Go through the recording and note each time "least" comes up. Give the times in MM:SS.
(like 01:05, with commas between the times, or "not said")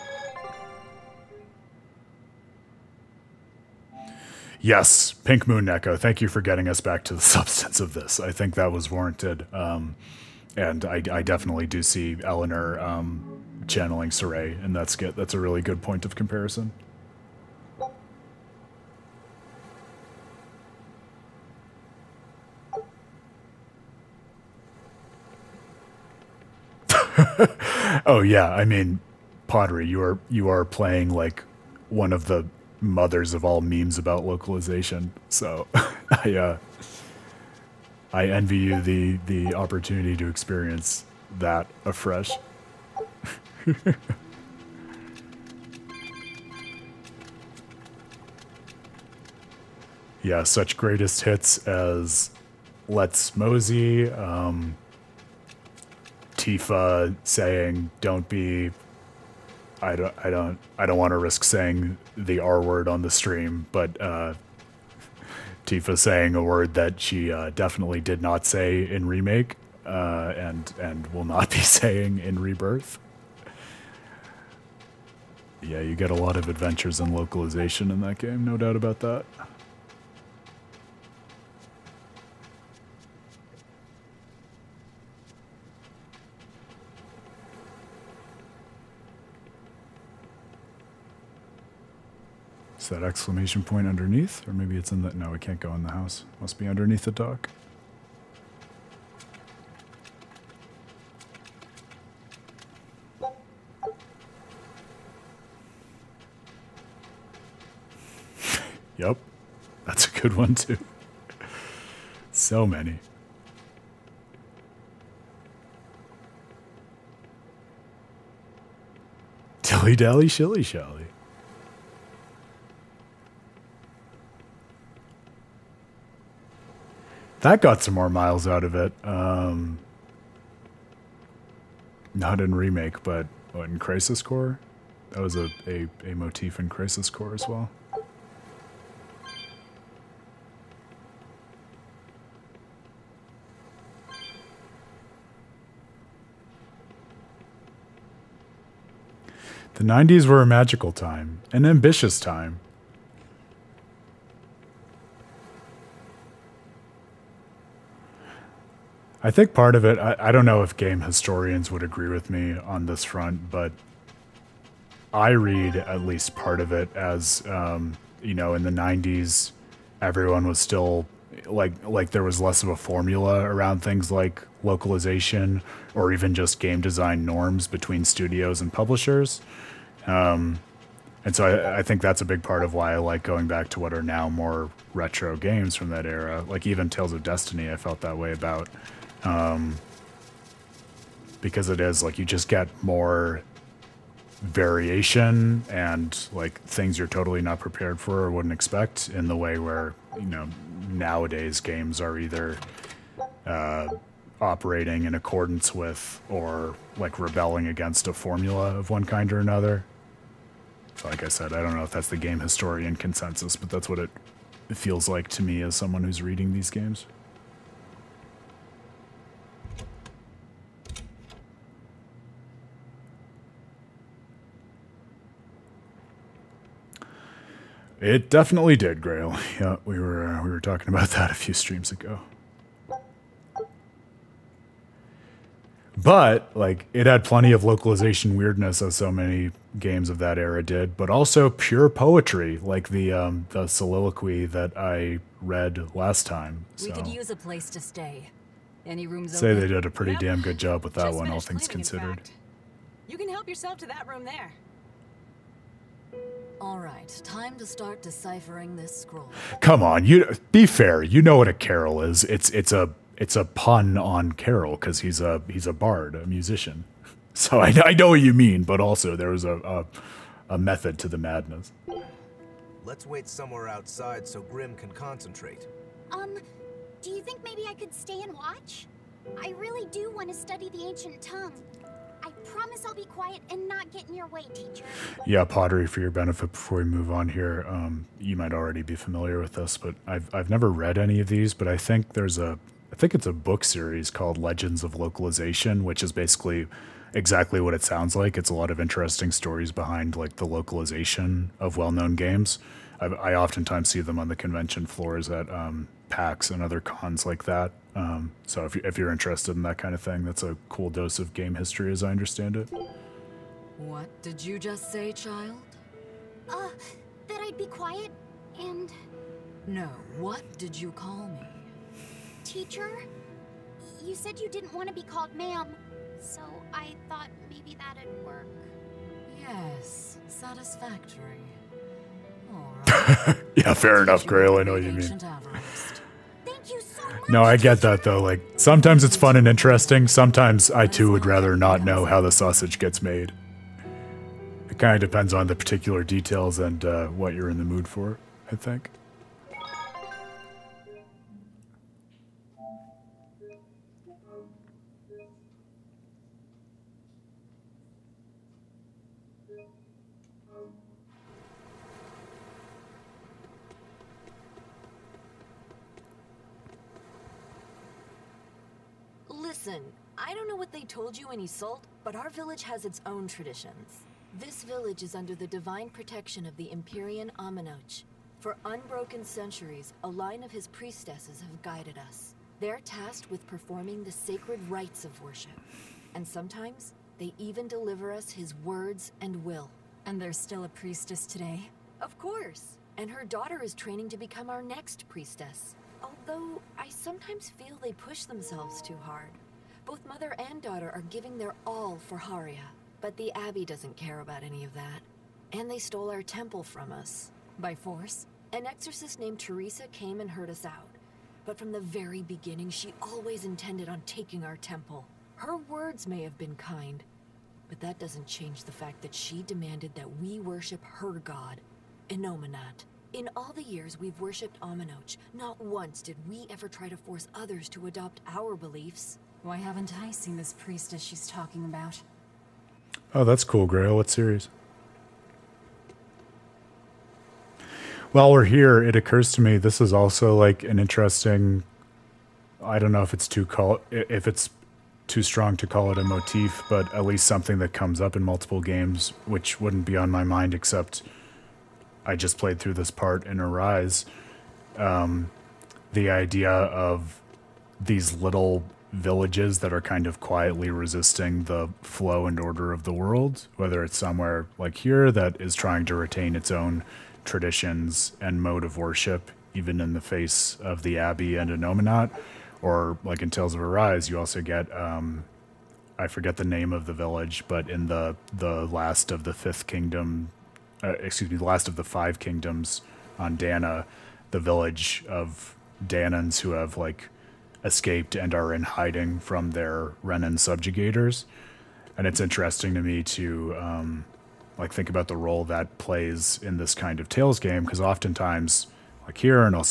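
02:46, 07:27.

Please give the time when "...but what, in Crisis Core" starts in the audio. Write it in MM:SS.
02:13.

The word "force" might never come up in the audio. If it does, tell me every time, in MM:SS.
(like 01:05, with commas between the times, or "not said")
06:47, 07:06.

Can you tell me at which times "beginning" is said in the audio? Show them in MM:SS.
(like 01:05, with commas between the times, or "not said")
06:52.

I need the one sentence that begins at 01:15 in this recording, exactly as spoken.
Yeah, you get a lot of adventures and localization in that game, no doubt about that.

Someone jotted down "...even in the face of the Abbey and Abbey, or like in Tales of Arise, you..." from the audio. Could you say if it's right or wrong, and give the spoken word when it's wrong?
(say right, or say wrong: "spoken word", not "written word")
wrong: "Innominat", not "Abbey".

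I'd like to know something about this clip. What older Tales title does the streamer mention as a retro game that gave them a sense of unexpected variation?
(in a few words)
Tales of Destiny.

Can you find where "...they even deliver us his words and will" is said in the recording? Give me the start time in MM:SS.
06:27.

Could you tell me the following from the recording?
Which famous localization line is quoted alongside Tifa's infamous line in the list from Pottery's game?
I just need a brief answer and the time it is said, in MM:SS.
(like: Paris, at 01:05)
Let's Mosey, at 00:52.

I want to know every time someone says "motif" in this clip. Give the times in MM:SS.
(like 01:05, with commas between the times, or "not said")
02:16, 07:26.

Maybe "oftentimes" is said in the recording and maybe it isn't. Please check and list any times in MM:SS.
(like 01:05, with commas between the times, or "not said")
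05:03, 08:17.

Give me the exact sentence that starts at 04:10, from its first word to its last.
damn good job with that Just one all things cleaning, considered.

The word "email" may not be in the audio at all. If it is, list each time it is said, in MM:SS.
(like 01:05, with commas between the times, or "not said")
not said.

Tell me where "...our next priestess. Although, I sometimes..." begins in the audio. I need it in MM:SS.
06:34.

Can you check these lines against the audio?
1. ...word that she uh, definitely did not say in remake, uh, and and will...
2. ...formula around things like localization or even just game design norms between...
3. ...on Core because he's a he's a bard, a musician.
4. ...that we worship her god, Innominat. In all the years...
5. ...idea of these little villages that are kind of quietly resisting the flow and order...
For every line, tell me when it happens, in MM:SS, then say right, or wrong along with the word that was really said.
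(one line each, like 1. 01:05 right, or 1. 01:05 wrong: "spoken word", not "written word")
1. 01:06 right
2. 02:52 right
3. 04:23 wrong: "Carol", not "Core"
4. 06:59 right
5. 07:36 right.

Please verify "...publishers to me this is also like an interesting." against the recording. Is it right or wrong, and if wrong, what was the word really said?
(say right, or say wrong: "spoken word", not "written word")
wrong: "occurs", not "publishers".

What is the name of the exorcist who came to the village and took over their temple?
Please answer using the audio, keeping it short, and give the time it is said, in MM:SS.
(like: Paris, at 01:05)
Teresa, at 06:49.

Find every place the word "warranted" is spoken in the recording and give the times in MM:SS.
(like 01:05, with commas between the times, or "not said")
00:08.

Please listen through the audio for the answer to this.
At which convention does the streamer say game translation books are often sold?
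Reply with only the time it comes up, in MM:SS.
05:06.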